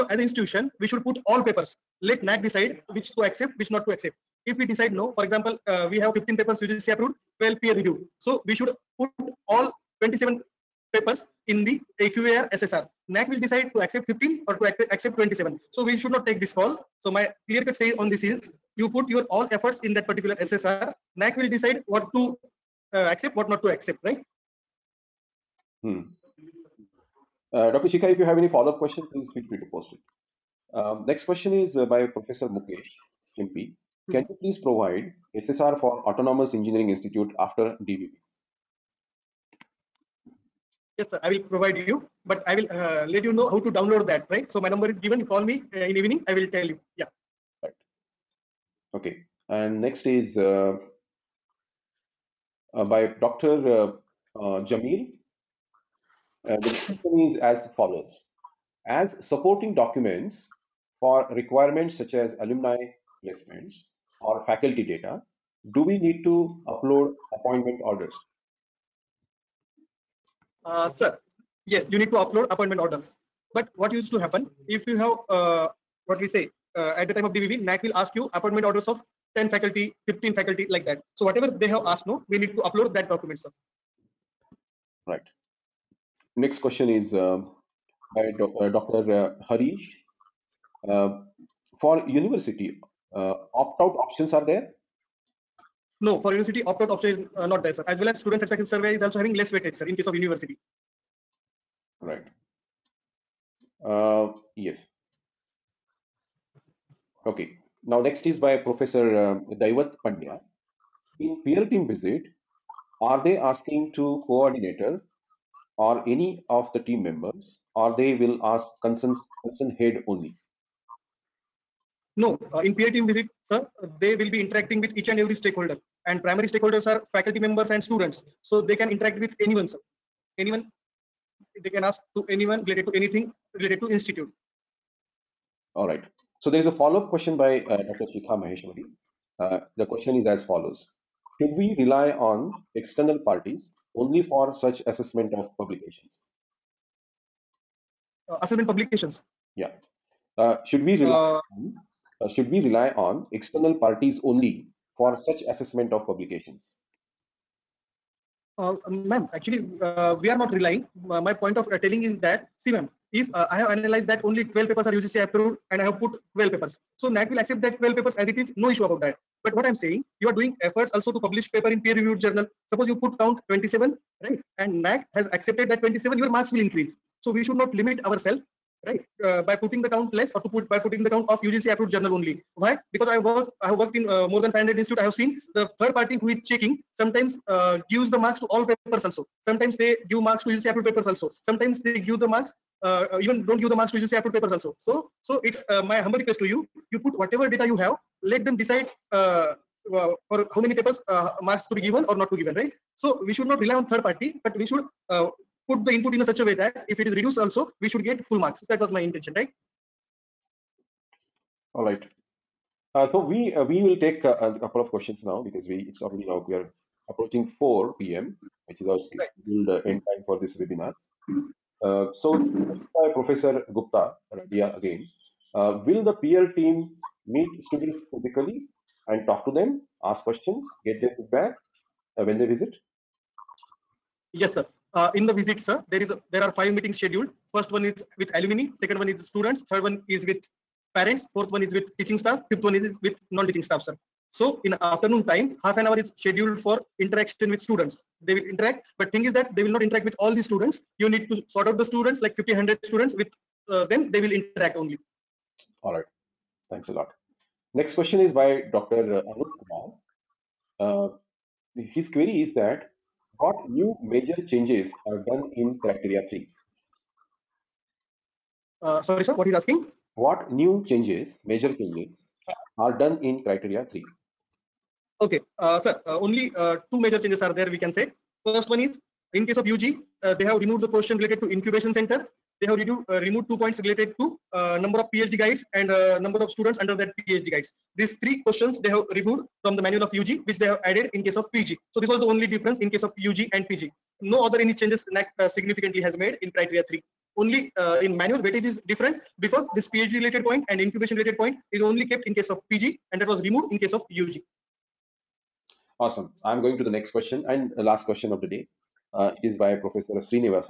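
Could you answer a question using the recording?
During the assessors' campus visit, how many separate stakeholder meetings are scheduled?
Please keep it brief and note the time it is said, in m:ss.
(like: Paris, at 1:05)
5, at 3:56.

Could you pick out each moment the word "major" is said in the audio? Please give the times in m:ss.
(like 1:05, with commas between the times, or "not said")
4:24, 4:31, 4:36.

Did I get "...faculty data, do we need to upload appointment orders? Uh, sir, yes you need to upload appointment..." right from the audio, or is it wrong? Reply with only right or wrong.
right.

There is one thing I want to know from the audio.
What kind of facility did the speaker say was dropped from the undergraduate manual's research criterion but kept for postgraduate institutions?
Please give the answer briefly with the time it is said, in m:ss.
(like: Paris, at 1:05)
incubation center, at 4:41.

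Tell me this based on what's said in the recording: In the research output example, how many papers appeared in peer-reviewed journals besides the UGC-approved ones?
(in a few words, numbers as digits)
12.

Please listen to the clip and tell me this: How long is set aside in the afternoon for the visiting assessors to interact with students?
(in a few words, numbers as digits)
half an hour.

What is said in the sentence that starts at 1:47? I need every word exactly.
Now, next is by Professor uh, Daivat Pandya.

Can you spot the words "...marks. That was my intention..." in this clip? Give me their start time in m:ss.
3:28.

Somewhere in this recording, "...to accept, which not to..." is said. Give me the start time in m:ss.
0:03.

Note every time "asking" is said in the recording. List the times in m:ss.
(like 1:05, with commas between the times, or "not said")
1:53, 4:29.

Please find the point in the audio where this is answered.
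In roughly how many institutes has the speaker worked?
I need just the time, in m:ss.
3:04.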